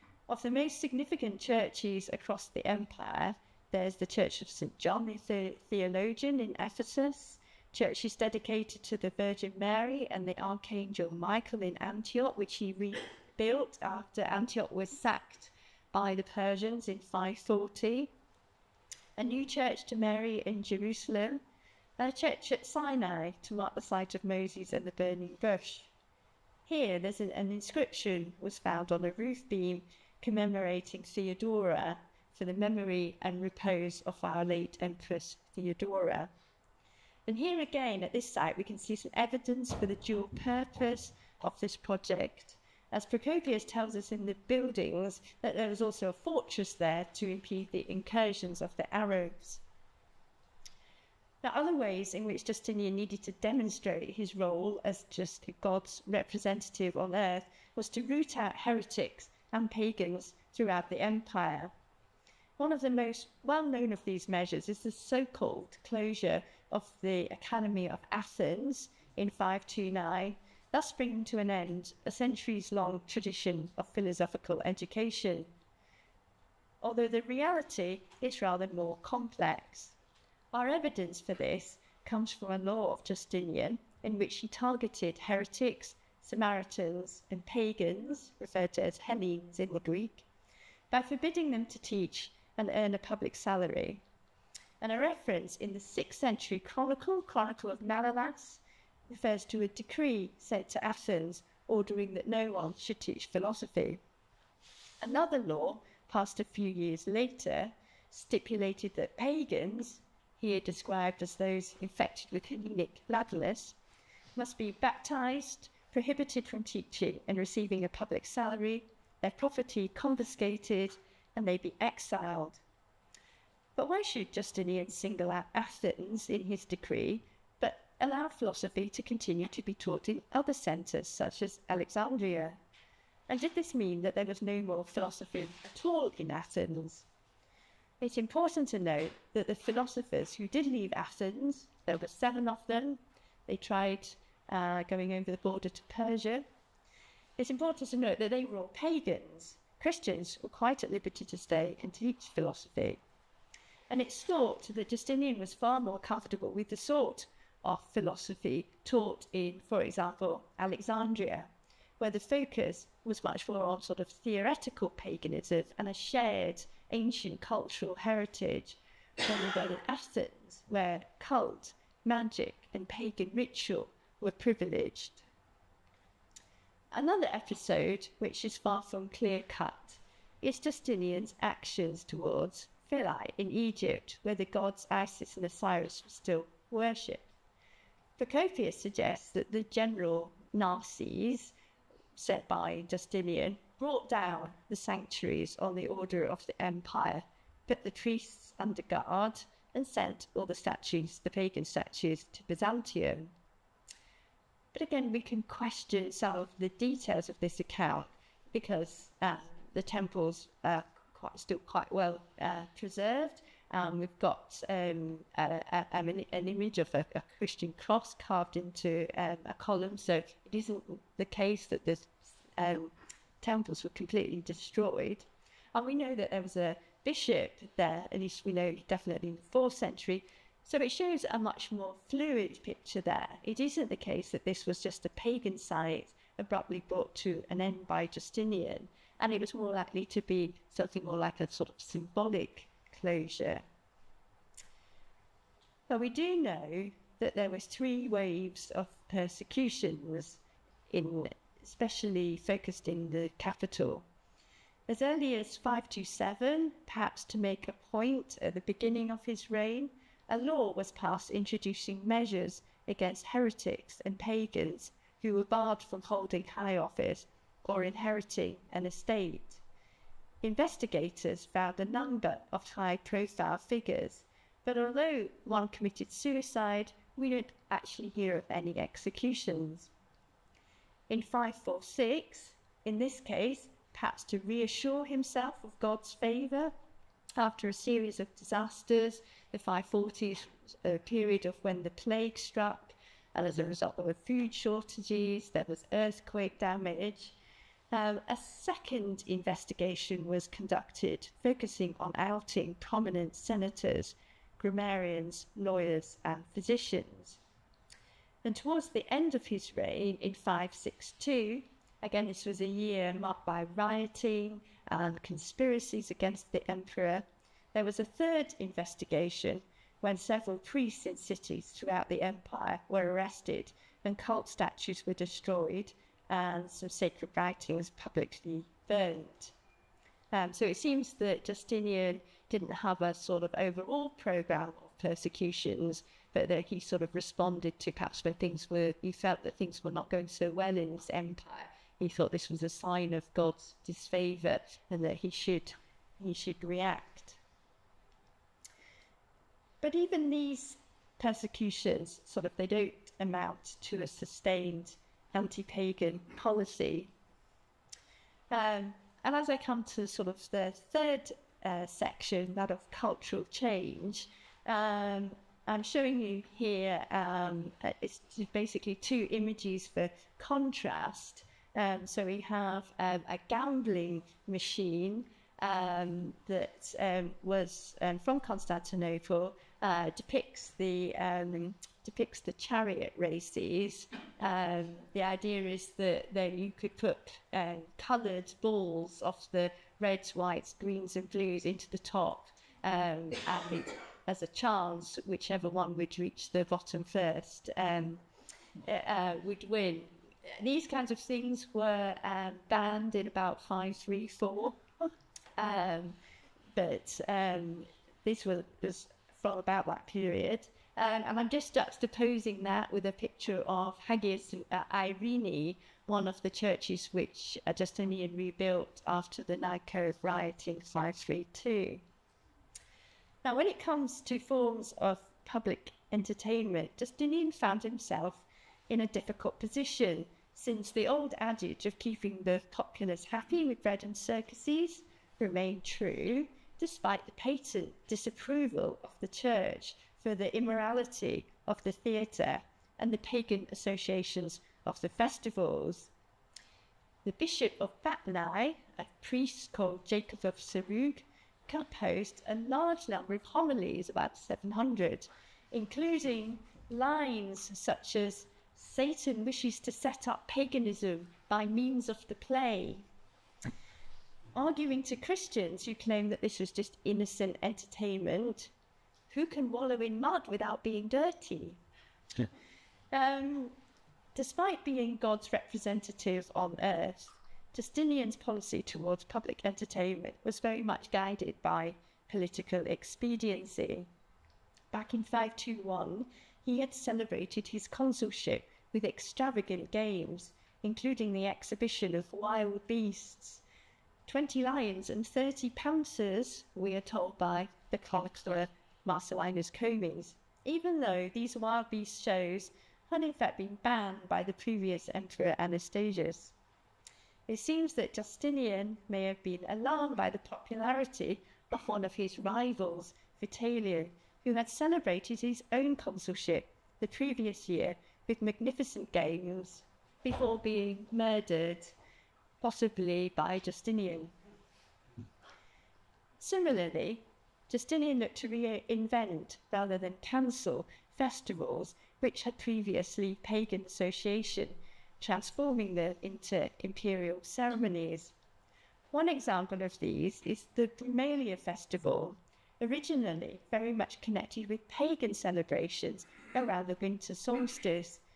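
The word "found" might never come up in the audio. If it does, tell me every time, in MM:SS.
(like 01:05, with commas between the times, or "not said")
00:28, 04:31, 07:07.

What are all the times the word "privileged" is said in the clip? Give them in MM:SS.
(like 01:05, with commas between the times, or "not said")
02:54.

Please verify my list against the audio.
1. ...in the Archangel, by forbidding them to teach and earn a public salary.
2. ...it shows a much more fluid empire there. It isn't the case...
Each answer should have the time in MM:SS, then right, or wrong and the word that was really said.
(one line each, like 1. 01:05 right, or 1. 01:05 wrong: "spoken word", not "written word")
1. 01:29 wrong: "Greek", not "Archangel"
2. 03:50 wrong: "picture", not "empire".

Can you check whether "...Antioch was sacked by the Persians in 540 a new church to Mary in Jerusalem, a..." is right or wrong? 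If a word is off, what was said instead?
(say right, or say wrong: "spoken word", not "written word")
right.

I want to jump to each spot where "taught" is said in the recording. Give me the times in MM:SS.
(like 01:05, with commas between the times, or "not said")
02:09, 02:38.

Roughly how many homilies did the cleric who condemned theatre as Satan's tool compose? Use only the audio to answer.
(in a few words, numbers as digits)
About 700.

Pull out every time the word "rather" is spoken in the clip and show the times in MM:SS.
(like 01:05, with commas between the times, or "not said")
01:18, 02:49, 08:49.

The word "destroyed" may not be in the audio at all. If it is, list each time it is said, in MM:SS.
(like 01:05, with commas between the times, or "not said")
03:44, 05:25.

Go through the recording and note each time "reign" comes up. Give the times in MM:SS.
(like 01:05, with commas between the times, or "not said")
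04:19, 05:09.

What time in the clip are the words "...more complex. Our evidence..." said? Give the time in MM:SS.
01:18.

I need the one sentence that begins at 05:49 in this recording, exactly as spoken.
But even these persecutions, sort of, they don't amount to a sustained anti-pagan policy.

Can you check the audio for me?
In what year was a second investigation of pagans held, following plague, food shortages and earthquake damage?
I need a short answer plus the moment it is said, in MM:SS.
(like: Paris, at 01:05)
546, at 04:41.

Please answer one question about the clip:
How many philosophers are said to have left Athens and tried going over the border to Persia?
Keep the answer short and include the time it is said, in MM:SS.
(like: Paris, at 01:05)
7, at 02:22.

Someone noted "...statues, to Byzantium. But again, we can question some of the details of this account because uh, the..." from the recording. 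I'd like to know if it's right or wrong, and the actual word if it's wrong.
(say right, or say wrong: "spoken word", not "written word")
right.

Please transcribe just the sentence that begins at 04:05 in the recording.
So we do know that there was three waves of persecutions, in, especially focused in the capital.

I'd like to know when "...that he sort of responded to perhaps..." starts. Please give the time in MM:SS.
05:36.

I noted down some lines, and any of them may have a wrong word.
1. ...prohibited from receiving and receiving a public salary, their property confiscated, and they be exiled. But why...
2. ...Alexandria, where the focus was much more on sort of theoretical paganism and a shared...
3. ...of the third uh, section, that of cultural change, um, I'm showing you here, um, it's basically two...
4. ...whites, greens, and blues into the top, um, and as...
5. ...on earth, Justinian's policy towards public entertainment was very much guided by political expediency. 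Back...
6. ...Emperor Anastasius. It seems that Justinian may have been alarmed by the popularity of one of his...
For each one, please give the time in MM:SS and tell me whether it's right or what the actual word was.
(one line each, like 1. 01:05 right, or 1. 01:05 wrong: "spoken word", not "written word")
1. 01:55 wrong: "teaching", not "receiving"
2. 02:40 right
3. 06:00 right
4. 06:30 right
5. 07:56 right
6. 08:25 right.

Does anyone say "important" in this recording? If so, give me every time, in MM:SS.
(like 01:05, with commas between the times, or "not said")
02:18, 02:27.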